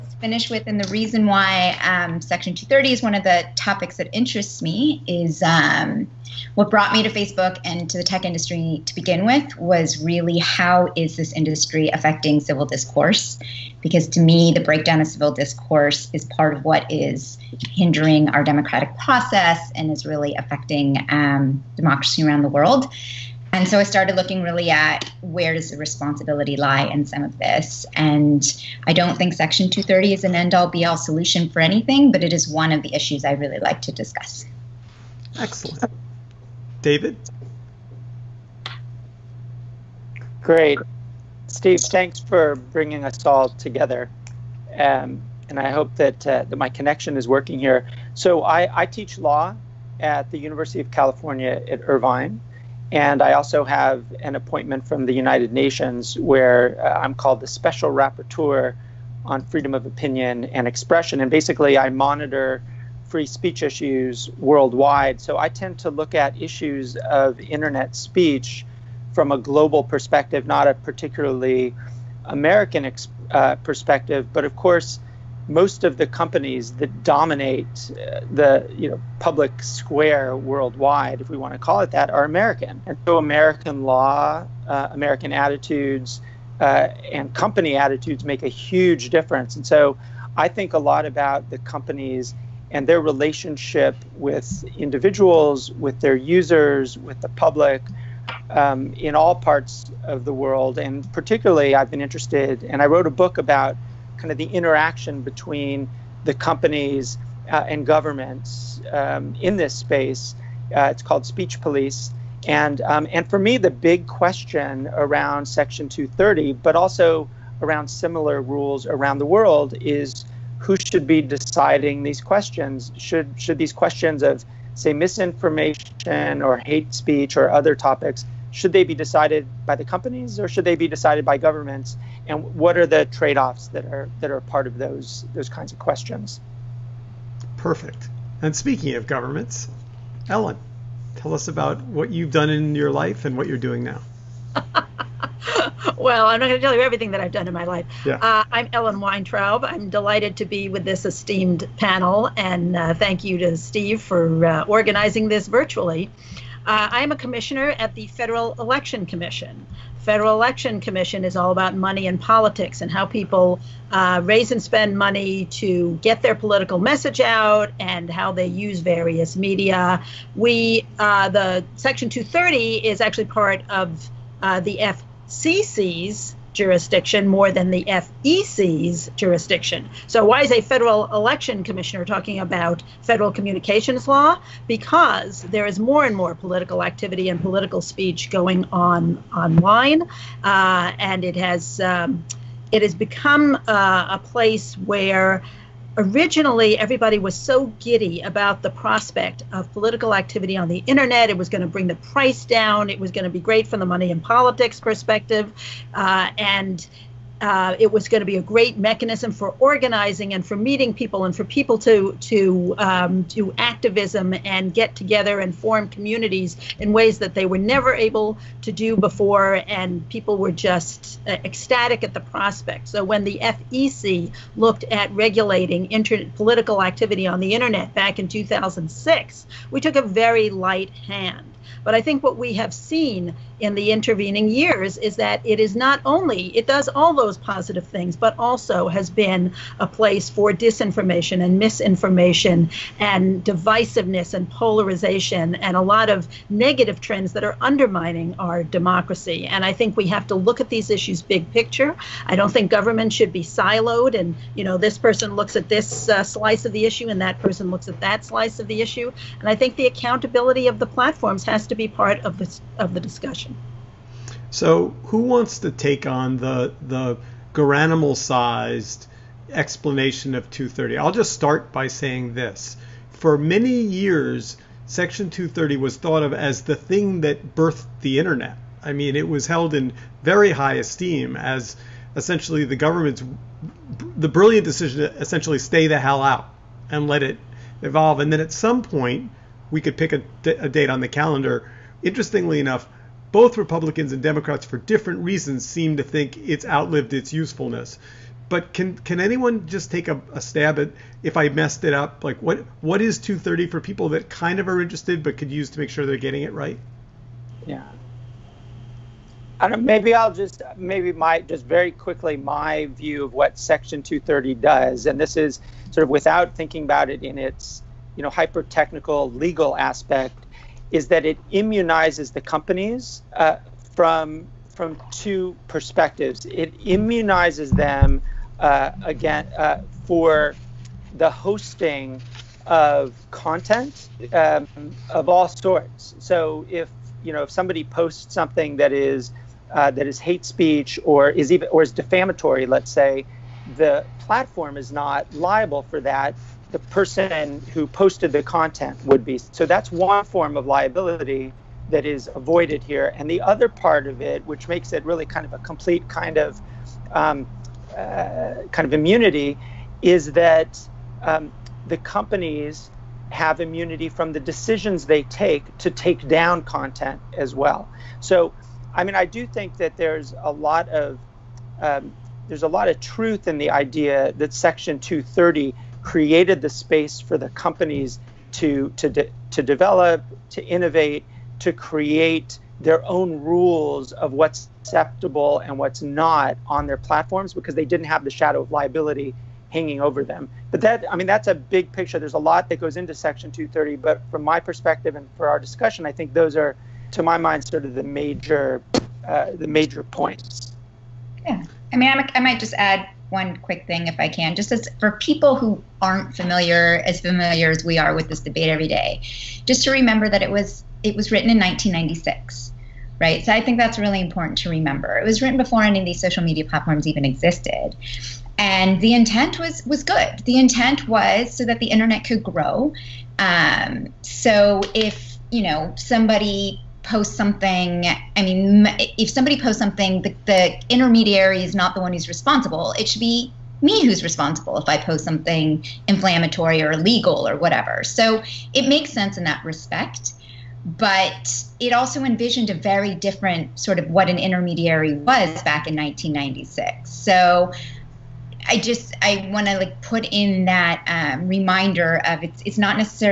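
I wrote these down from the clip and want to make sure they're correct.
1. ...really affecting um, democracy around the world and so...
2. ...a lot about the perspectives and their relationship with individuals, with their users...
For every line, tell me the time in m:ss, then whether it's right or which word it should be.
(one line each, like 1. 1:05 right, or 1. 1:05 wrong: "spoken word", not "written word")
1. 0:20 right
2. 1:30 wrong: "companies", not "perspectives".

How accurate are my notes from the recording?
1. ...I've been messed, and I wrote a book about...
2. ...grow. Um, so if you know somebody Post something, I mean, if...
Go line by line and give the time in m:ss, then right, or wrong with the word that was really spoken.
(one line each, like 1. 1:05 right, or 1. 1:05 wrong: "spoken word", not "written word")
1. 1:41 wrong: "interested", not "messed"
2. 7:02 right.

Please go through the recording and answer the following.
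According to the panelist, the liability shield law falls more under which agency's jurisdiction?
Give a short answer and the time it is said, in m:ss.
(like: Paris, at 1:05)
FCC, at 2:54.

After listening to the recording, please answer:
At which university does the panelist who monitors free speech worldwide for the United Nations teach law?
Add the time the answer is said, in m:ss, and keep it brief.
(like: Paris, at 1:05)
University of California at Irvine, at 0:50.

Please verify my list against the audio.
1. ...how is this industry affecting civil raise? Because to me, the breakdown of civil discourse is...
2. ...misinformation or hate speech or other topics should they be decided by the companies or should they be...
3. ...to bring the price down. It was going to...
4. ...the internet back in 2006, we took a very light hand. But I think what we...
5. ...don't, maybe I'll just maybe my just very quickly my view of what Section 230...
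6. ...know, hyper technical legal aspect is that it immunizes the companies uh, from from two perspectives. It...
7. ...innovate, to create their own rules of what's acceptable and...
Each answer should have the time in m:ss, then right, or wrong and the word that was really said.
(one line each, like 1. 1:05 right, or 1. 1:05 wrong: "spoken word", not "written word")
1. 0:10 wrong: "discourse", not "raise"
2. 2:04 right
3. 3:21 right
4. 3:47 right
5. 5:09 right
6. 5:18 right
7. 6:20 right.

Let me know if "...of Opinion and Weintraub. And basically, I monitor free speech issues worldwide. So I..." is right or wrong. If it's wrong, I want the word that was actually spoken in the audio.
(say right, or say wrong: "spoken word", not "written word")
wrong: "Expression", not "Weintraub".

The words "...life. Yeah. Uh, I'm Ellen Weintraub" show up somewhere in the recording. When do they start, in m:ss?
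2:27.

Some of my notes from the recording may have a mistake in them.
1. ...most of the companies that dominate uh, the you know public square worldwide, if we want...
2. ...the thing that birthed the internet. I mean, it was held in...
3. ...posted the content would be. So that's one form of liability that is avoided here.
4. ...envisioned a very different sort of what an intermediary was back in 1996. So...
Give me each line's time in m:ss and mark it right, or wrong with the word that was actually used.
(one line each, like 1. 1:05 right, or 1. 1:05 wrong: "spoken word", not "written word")
1. 1:15 right
2. 4:36 right
3. 5:47 right
4. 7:22 right.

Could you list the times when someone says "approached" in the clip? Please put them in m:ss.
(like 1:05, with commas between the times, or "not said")
not said.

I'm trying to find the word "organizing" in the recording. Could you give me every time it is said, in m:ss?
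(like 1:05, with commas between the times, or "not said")
2:34, 3:29.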